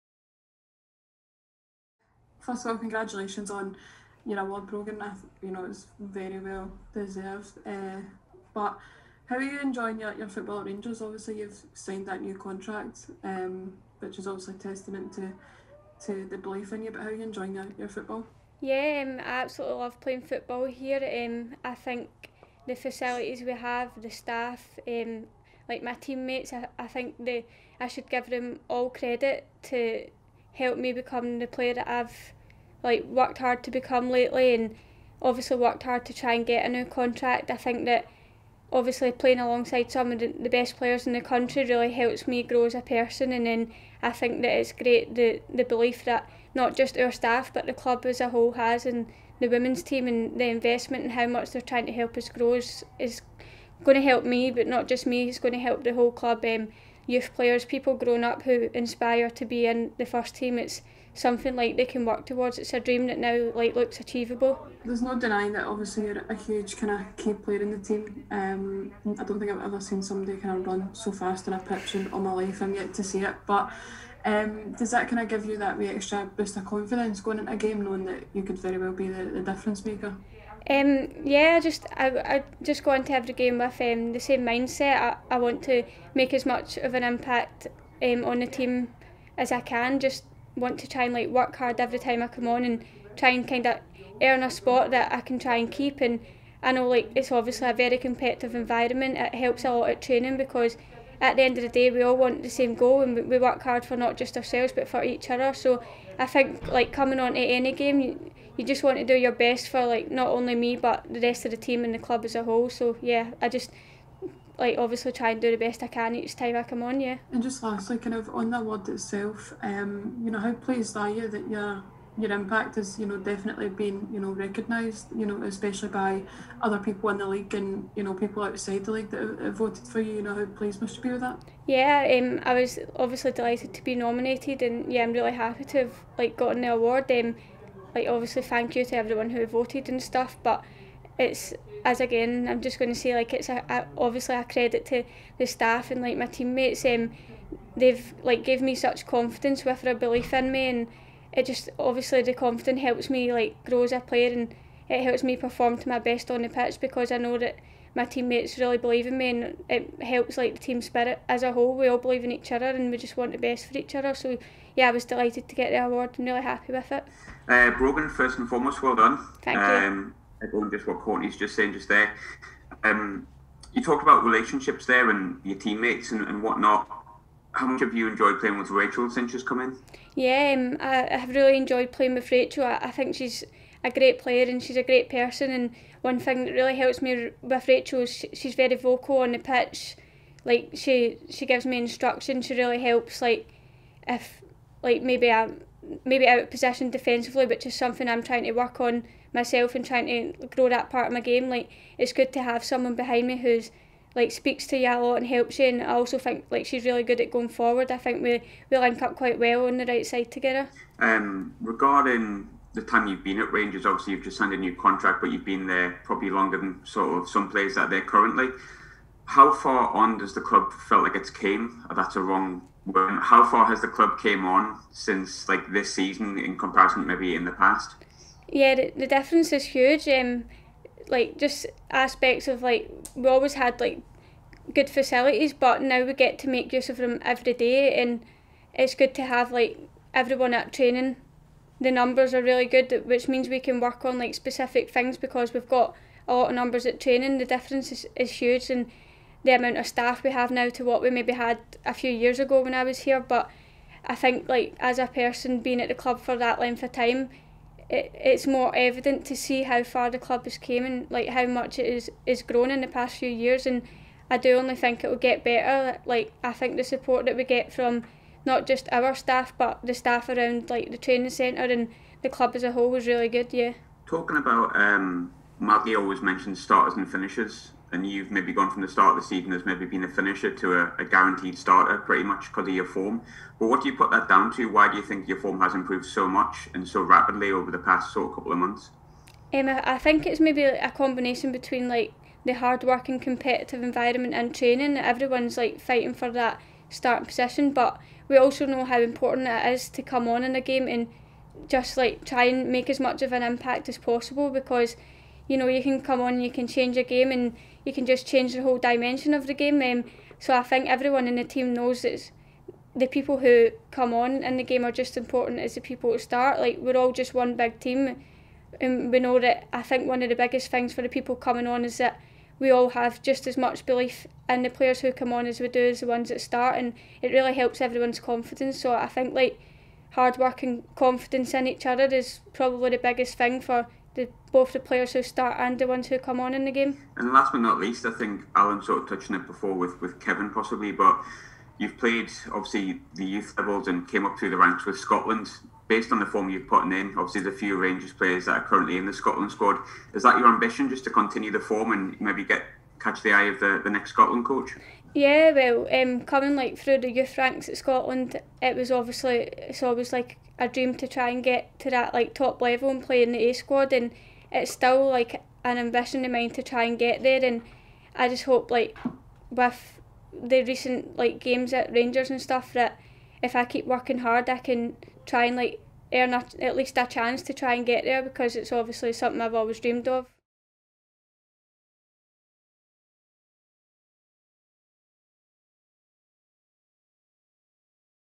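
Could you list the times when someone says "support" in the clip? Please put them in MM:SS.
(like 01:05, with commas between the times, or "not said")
04:26.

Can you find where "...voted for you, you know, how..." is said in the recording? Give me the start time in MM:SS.
02:09.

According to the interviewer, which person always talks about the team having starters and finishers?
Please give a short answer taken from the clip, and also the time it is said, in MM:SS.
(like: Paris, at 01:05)
Malky, at 04:35.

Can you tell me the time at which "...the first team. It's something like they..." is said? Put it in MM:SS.
00:59.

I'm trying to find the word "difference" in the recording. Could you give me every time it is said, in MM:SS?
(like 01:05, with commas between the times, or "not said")
01:19, 03:49, 04:07.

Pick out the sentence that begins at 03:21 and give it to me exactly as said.
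Like it's good to have someone behind me who's like speaks to you a lot and helps you.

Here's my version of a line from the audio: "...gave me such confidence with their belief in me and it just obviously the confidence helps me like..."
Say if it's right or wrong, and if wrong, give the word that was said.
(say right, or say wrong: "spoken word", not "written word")
right.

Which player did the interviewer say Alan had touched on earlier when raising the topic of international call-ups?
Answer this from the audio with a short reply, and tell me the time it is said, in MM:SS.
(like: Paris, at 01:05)
Kevin, at 05:40.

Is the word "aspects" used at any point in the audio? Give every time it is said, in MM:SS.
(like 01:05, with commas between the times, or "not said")
03:51.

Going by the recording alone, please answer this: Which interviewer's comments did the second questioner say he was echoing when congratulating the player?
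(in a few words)
Courtney.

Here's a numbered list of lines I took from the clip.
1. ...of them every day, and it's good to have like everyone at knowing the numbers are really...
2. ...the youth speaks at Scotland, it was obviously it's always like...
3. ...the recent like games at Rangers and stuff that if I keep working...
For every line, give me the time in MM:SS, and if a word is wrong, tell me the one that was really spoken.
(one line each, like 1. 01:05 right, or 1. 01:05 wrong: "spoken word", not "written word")
1. 03:56 wrong: "training", not "knowing"
2. 05:56 wrong: "ranks", not "speaks"
3. 06:10 right.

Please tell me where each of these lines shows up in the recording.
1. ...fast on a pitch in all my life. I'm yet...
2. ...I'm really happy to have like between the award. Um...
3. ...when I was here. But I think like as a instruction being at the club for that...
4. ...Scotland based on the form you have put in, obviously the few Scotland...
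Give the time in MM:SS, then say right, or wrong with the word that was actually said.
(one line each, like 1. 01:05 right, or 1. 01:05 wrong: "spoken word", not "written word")
1. 01:11 right
2. 02:15 wrong: "gotten", not "between"
3. 04:12 wrong: "person", not "instruction"
4. 05:44 wrong: "Rangers", not "Scotland".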